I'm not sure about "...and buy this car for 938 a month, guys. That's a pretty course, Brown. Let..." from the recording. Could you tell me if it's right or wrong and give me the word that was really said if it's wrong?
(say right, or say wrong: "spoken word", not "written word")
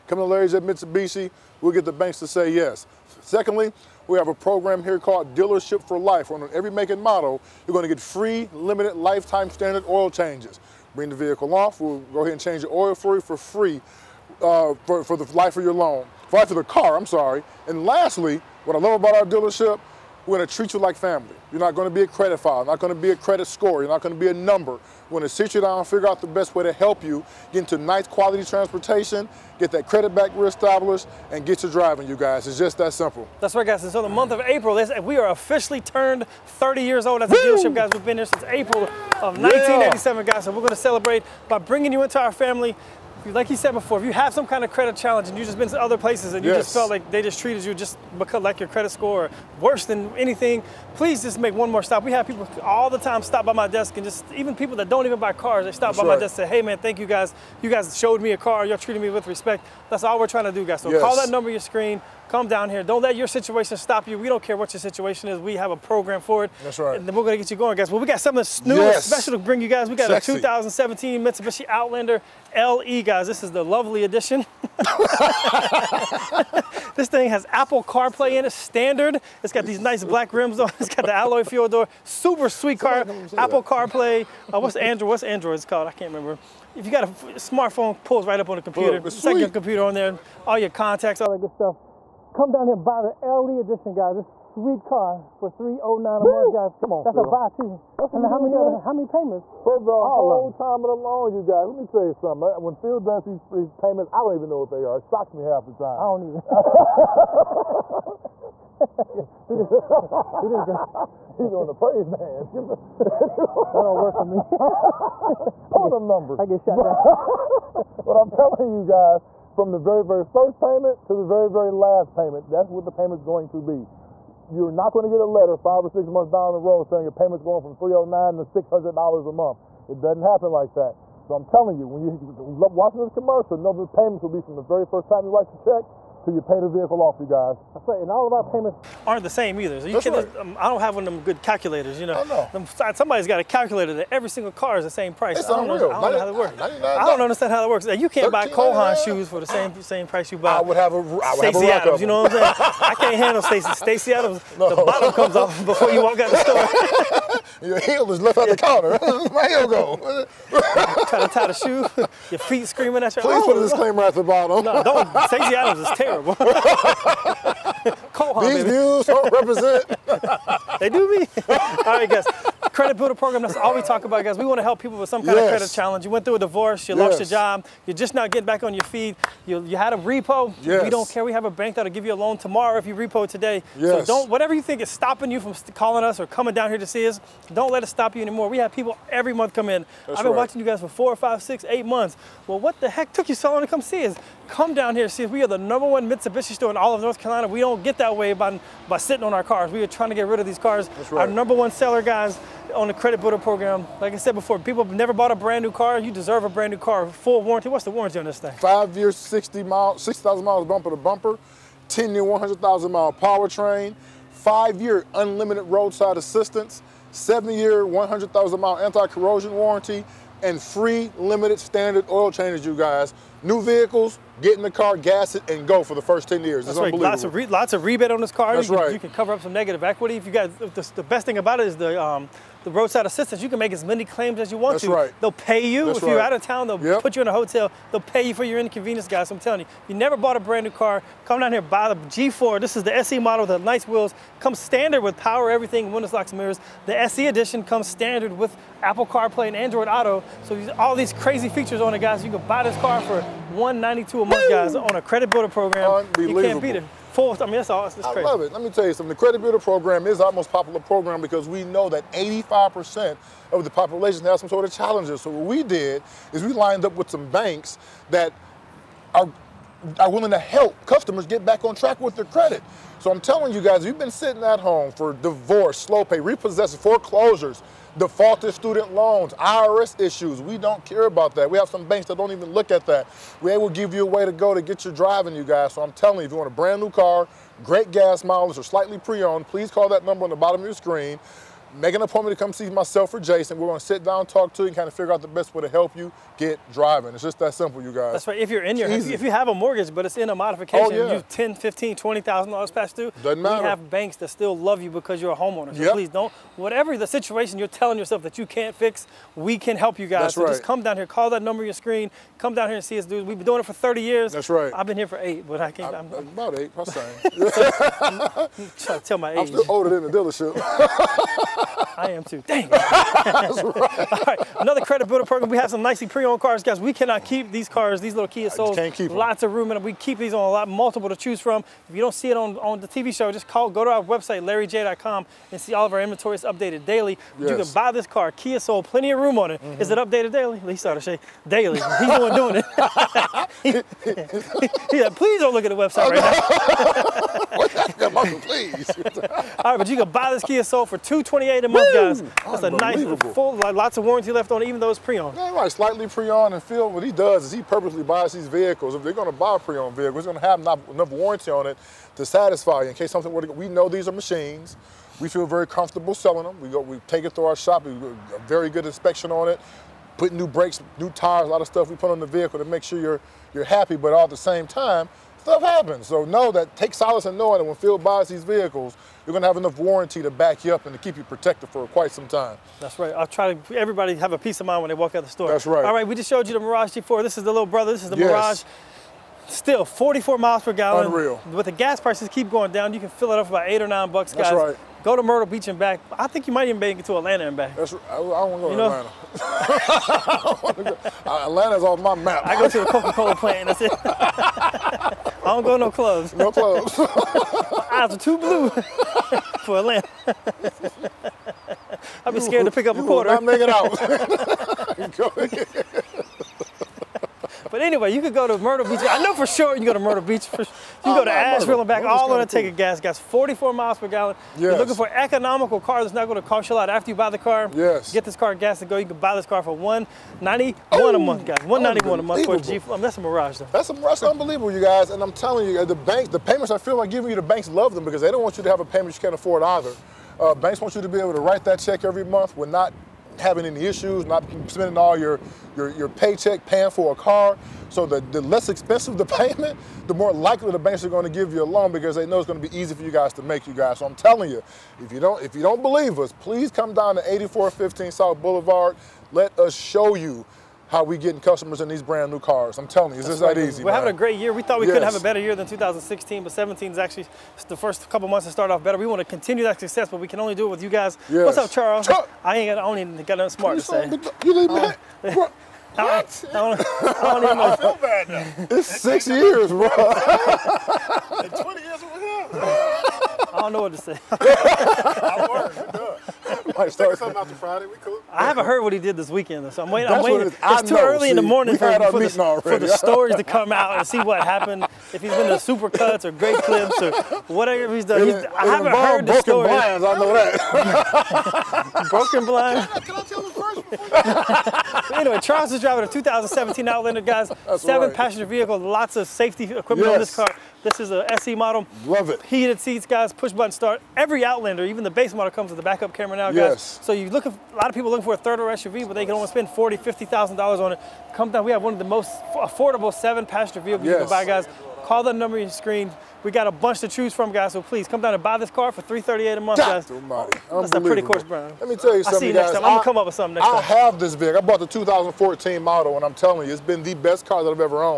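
wrong: "338", not "938".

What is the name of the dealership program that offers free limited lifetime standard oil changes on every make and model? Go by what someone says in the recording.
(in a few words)
Dealership for Life.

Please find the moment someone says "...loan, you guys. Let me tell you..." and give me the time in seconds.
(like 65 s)
101 s.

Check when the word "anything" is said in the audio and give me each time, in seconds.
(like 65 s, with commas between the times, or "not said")
50 s.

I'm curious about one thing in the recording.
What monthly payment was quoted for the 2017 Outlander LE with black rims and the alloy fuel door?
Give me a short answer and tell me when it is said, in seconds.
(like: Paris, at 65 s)
$309, at 95 s.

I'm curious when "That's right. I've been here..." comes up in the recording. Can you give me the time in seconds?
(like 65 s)
314 s.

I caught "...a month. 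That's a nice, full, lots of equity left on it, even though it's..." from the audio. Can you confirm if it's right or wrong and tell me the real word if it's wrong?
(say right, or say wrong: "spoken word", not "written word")
wrong: "warranty", not "equity".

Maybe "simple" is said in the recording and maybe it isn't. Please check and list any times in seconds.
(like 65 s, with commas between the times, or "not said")
32 s, 297 s.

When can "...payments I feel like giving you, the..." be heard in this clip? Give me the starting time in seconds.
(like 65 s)
436 s.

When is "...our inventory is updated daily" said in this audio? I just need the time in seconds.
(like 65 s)
335 s.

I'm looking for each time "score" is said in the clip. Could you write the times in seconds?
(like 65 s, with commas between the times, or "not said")
23 s, 48 s.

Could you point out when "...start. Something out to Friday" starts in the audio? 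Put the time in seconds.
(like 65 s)
486 s.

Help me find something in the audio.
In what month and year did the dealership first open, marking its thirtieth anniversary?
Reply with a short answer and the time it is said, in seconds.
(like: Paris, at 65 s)
April 1987, at 38 s.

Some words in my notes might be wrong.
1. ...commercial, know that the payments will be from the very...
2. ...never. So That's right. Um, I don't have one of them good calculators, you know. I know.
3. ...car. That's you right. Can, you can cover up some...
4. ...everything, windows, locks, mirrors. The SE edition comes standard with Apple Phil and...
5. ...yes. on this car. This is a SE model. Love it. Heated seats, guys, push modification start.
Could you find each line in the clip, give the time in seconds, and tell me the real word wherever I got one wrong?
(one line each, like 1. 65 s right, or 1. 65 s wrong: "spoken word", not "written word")
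1. 133 s right
2. 139 s wrong: "either", not "never"
3. 228 s right
4. 245 s wrong: "CarPlay", not "Phil"
5. 509 s wrong: "button", not "modification".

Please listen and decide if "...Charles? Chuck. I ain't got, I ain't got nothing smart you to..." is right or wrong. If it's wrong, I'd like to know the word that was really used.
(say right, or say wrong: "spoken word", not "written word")
right.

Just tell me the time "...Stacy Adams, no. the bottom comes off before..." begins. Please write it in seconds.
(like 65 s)
153 s.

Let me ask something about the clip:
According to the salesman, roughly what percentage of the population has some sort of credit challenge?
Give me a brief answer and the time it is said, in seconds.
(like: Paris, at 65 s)
85%, at 262 s.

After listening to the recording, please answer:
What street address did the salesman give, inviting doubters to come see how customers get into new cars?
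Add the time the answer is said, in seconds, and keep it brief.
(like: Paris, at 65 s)
8415 South Boulevard, at 457 s.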